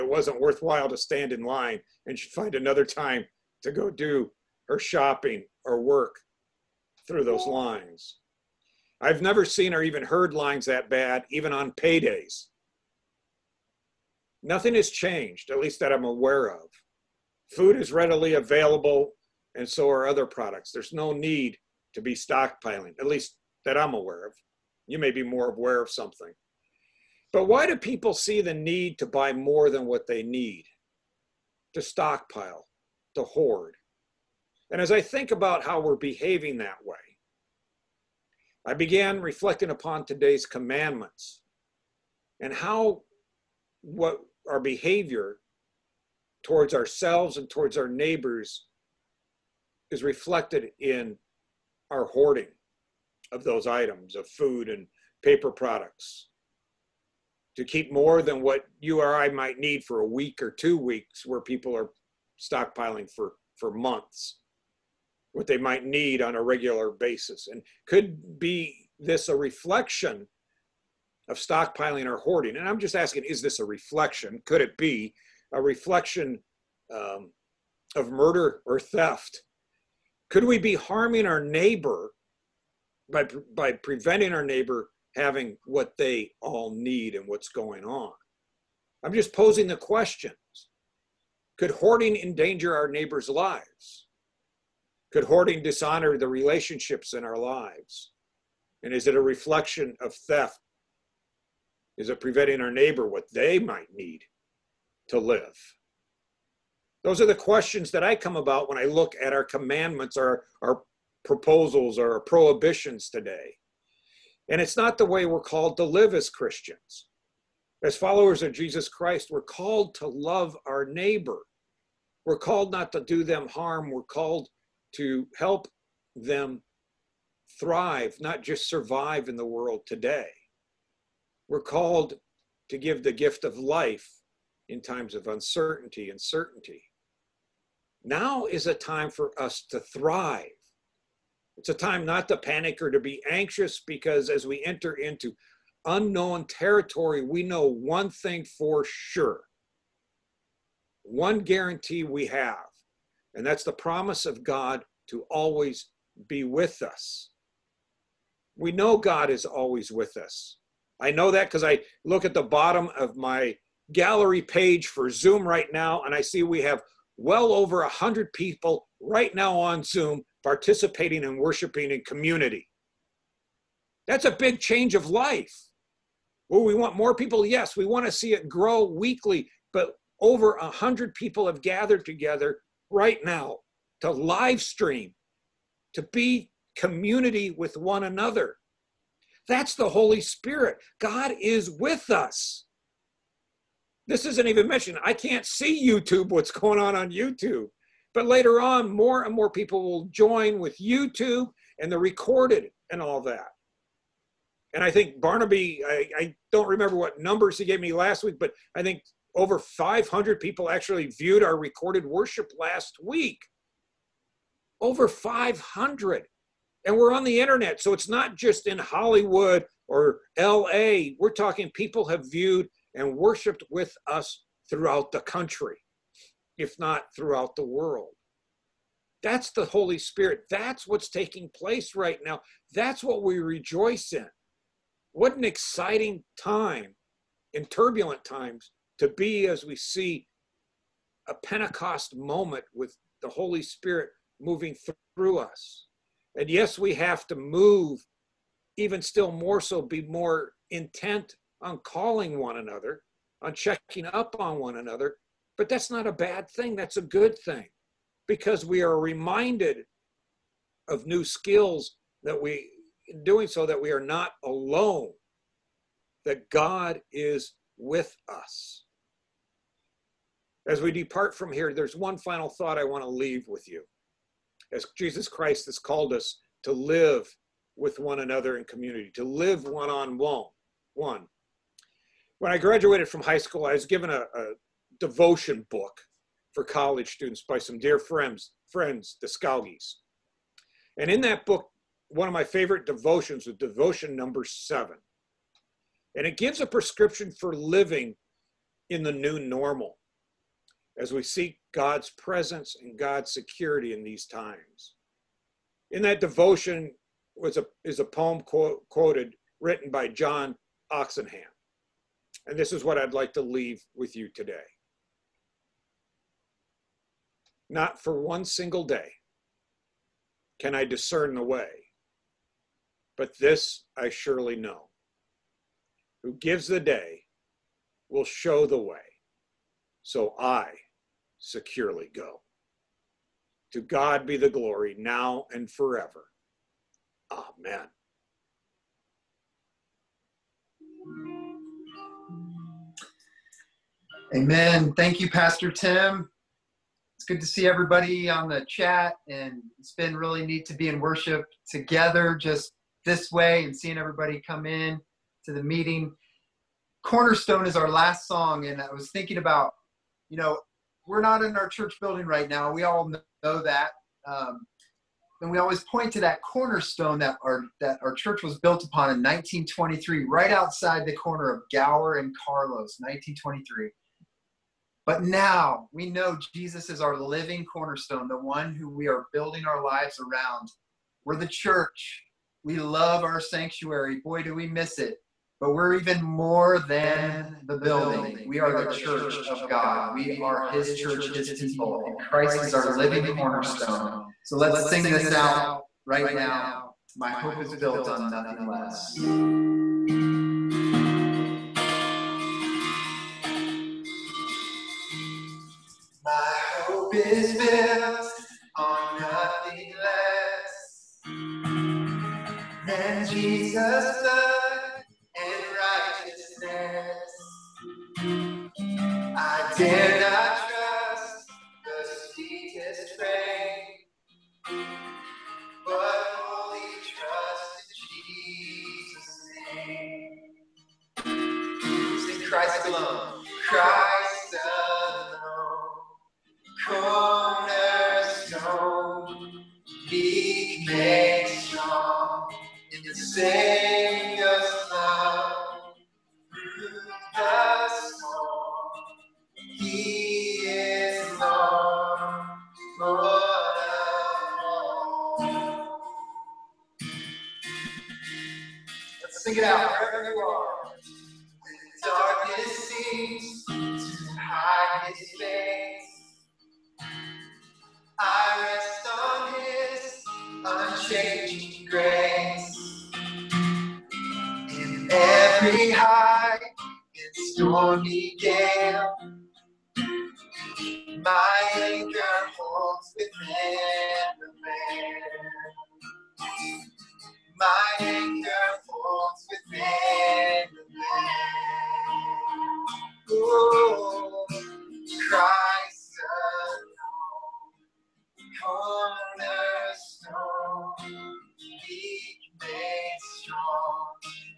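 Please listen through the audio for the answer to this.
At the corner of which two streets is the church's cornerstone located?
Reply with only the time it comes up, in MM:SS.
06:11.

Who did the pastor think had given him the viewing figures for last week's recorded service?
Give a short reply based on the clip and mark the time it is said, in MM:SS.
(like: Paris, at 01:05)
Barnaby, at 03:25.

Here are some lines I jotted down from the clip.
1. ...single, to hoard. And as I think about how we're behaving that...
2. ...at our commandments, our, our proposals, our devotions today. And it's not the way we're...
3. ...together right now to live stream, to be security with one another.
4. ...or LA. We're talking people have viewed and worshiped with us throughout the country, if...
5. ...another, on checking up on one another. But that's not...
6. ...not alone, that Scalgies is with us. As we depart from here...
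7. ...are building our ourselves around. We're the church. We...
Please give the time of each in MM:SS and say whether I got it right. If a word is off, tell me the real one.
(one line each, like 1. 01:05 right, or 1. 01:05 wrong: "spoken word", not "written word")
1. 00:31 wrong: "stockpile", not "single"
2. 01:49 wrong: "prohibitions", not "devotions"
3. 03:02 wrong: "community", not "security"
4. 03:39 right
5. 04:12 right
6. 04:23 wrong: "God", not "Scalgies"
7. 06:19 wrong: "lives", not "ourselves".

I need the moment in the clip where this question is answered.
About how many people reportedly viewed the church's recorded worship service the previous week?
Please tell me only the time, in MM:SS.
03:29.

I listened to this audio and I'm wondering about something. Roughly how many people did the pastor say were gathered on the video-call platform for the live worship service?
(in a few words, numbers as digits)
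over 100.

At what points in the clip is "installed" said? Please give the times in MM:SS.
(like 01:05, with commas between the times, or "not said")
not said.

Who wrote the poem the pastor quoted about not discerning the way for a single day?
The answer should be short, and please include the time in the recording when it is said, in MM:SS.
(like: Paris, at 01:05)
John Oxenham, at 05:10.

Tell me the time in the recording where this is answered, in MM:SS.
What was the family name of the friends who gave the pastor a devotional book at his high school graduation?
04:49.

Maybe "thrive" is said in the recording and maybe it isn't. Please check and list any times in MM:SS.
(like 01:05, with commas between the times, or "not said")
02:07, 02:19.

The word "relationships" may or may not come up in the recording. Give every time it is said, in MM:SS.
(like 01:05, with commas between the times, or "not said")
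01:36.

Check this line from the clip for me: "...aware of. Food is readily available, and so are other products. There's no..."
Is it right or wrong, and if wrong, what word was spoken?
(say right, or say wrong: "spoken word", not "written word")
right.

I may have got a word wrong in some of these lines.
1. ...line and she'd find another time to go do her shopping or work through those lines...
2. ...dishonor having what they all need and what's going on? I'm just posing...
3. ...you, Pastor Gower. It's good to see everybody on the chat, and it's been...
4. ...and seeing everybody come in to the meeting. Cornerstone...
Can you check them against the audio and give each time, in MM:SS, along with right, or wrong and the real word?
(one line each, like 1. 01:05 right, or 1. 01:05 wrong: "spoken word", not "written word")
1. 00:01 right
2. 01:24 wrong: "neighbor", not "dishonor"
3. 05:45 wrong: "Tim", not "Gower"
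4. 05:53 right.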